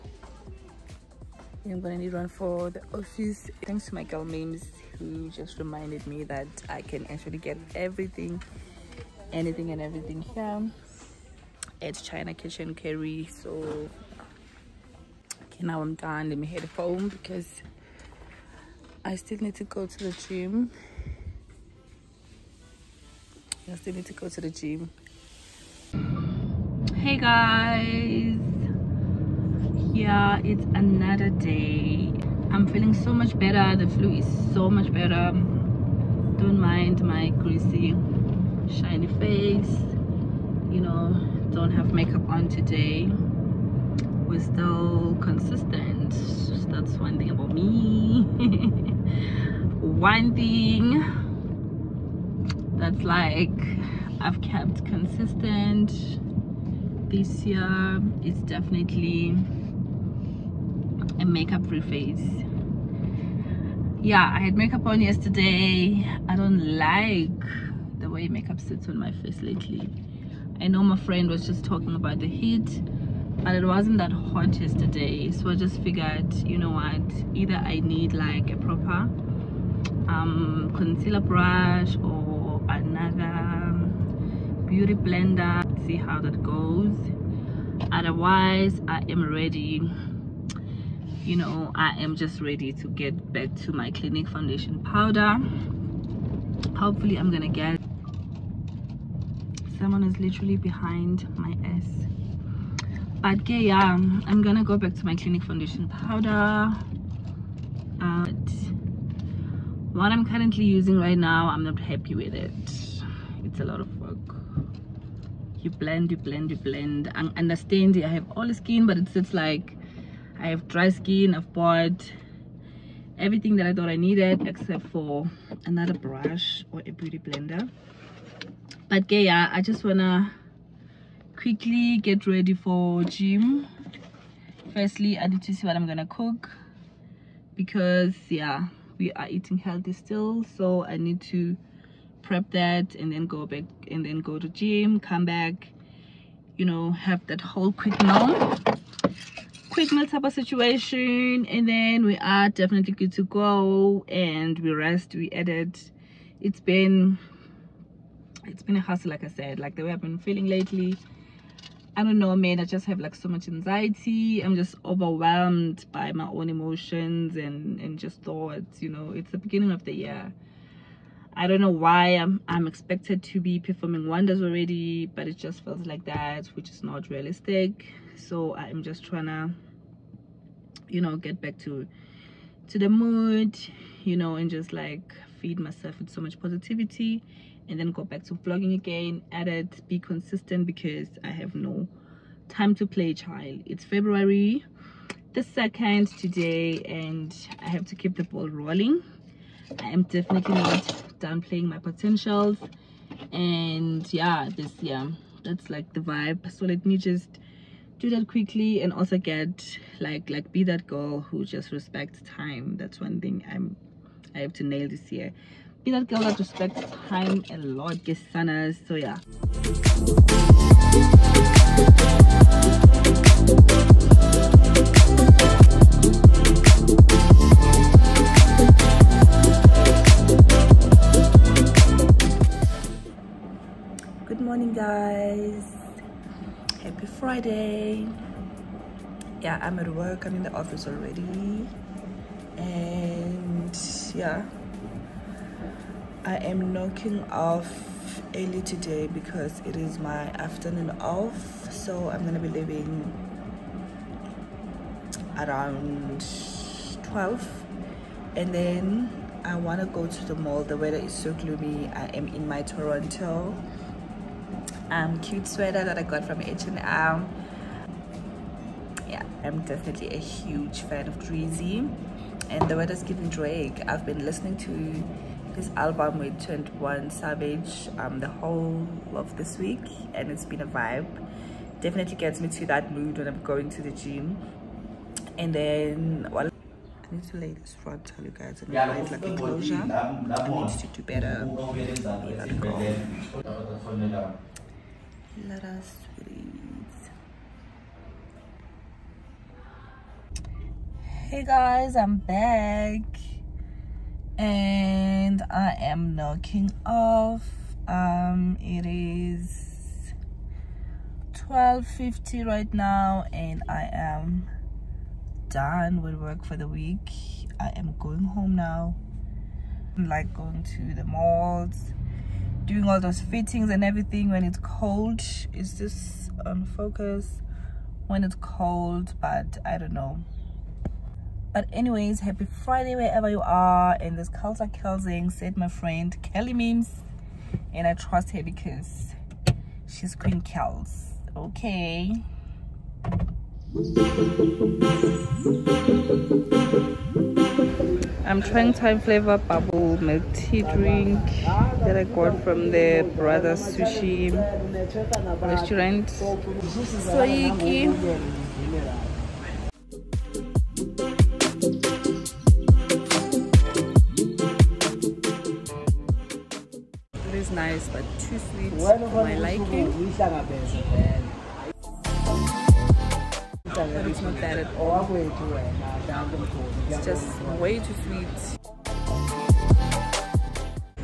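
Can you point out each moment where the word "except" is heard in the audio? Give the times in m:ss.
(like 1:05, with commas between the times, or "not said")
2:04.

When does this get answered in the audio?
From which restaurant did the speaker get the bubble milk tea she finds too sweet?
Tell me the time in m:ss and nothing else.
5:53.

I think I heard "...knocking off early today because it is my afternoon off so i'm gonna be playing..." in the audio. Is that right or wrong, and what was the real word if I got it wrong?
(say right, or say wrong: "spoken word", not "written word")
wrong: "leaving", not "playing".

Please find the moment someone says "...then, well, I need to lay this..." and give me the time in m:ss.
4:45.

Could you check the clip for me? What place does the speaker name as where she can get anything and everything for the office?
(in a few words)
China Kitchen Curry.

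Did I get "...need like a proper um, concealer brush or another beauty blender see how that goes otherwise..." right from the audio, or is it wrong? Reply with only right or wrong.
right.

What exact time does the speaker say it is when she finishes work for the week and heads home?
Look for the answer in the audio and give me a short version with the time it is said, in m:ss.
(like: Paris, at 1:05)
12:50, at 5:11.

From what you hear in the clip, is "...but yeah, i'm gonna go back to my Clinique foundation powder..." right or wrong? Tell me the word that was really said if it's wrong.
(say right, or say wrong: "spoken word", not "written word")
right.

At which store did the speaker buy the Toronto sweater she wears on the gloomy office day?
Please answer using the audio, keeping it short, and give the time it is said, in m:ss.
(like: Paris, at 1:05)
H&M, at 4:26.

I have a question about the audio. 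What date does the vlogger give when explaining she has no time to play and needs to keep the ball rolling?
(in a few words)
February 2nd.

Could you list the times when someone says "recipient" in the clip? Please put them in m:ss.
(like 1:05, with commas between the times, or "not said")
not said.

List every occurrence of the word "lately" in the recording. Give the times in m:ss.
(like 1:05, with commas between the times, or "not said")
1:09, 2:40.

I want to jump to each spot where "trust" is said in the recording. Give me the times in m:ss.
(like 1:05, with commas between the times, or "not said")
5:37.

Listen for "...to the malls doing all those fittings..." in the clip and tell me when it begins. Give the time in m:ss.
5:20.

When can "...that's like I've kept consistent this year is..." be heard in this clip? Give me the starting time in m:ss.
0:52.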